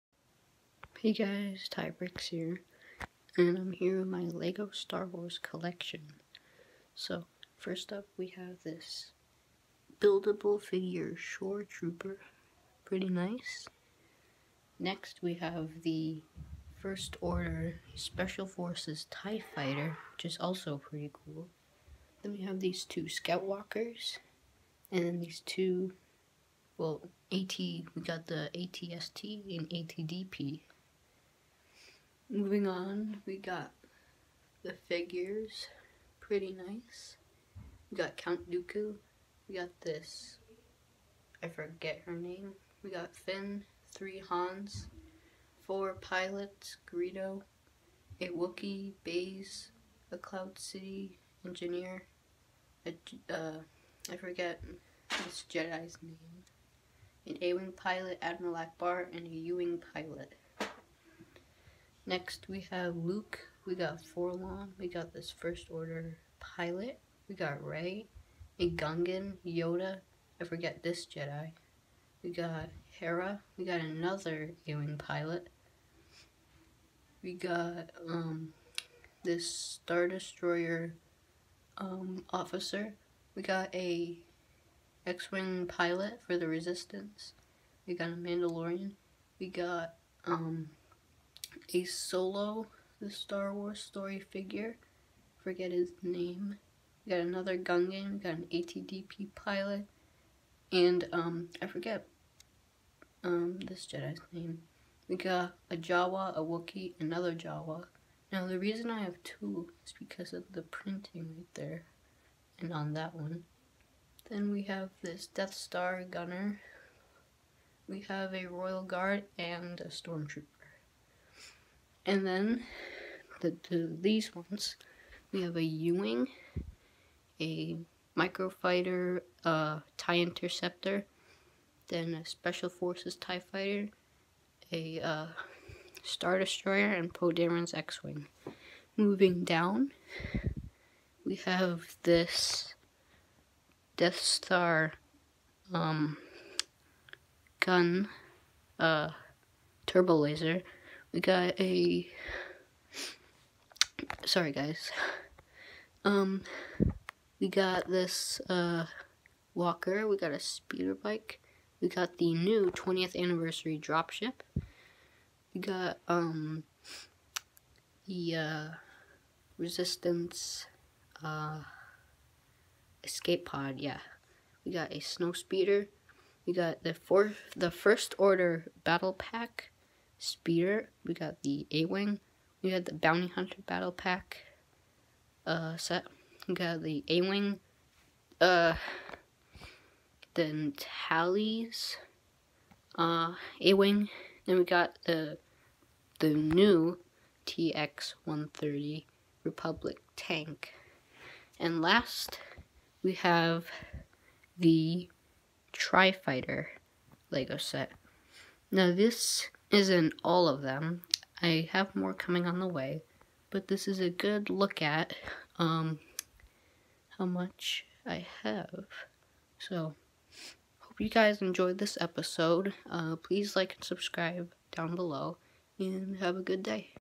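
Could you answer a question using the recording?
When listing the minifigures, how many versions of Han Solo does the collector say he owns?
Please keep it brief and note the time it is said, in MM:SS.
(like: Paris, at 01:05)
3, at 00:43.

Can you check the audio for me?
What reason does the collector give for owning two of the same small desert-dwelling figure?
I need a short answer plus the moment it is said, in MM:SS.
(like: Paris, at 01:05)
The printing, at 01:50.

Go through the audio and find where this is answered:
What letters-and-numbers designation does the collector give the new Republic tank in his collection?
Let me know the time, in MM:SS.
03:17.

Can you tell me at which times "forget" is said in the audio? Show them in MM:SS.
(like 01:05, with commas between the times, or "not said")
00:41, 00:54, 01:10, 01:35, 01:41.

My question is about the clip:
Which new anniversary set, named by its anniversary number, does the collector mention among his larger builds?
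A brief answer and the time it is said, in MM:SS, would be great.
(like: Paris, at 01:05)
20th anniversary dropship, at 02:42.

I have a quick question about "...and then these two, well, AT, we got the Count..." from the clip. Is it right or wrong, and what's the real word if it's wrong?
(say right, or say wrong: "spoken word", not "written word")
wrong: "ATST", not "Count".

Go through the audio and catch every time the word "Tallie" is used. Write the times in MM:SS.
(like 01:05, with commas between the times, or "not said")
03:10.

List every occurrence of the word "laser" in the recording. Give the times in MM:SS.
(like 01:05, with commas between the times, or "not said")
02:30.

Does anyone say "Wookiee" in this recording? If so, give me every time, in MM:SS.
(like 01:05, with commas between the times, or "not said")
00:48, 01:46.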